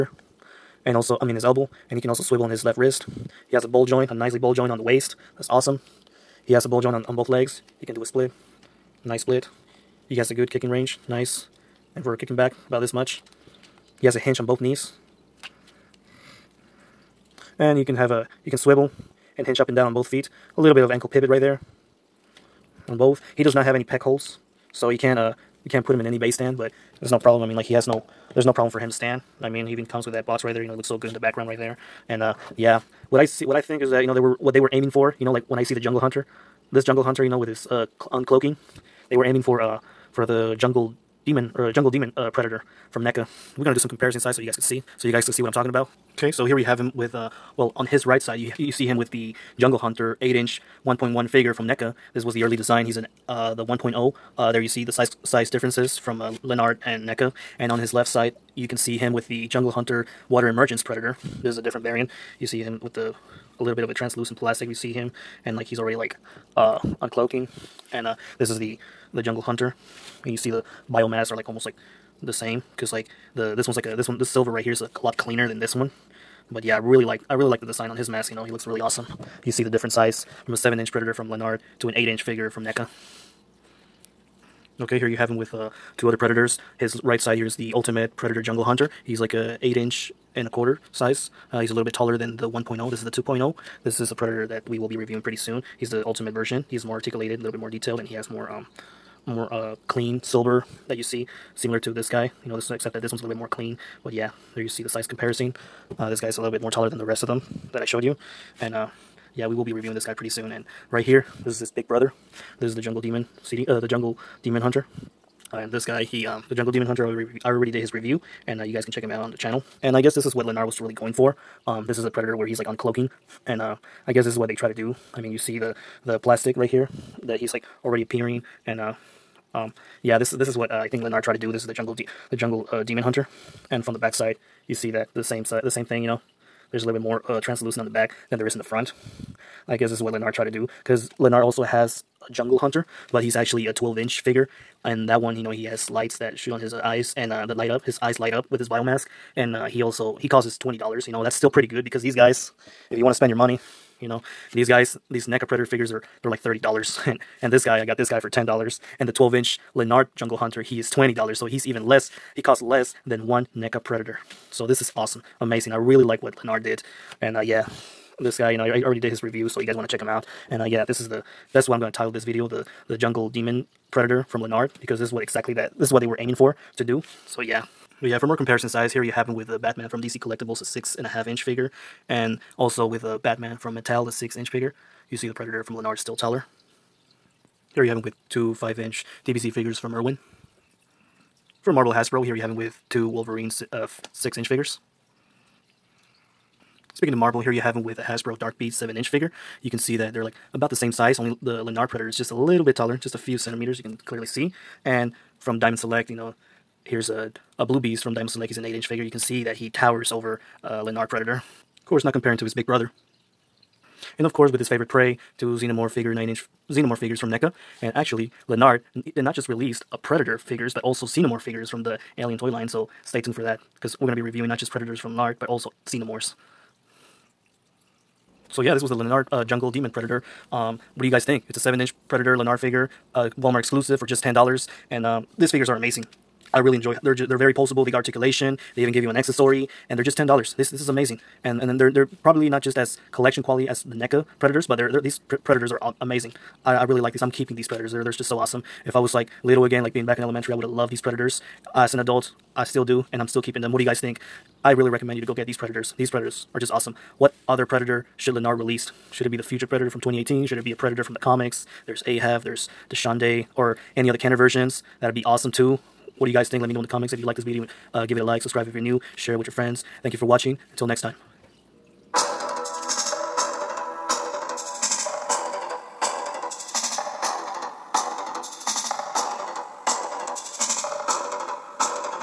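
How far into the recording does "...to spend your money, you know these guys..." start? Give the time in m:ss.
2:33.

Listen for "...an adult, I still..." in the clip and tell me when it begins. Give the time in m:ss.
4:11.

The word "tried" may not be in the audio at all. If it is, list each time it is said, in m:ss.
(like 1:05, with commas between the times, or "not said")
2:11, 2:20.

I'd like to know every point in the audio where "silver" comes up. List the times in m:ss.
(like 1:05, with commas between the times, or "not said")
1:14, 1:40.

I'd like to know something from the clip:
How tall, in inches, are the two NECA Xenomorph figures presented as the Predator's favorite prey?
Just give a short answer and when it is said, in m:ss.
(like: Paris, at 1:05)
9 inches, at 3:36.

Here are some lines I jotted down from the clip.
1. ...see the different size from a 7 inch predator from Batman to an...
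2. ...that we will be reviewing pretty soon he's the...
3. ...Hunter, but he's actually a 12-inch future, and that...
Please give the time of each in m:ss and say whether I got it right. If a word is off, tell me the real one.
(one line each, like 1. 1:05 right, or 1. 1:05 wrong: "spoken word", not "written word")
1. 1:19 wrong: "Lanard", not "Batman"
2. 1:34 right
3. 2:22 wrong: "figure", not "future".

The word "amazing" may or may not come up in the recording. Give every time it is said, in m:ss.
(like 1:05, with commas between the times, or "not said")
2:45, 3:55, 4:00, 4:06.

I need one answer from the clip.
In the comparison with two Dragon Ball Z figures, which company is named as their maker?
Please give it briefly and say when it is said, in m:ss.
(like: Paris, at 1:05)
Irwin, at 3:09.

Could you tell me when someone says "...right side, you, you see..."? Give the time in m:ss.
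0:48.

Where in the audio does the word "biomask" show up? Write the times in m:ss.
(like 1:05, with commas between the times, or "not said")
1:10, 2:28.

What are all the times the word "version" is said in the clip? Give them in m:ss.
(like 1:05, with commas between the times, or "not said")
1:36, 4:24.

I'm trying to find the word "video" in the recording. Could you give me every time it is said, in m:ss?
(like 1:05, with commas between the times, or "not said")
2:52, 4:27.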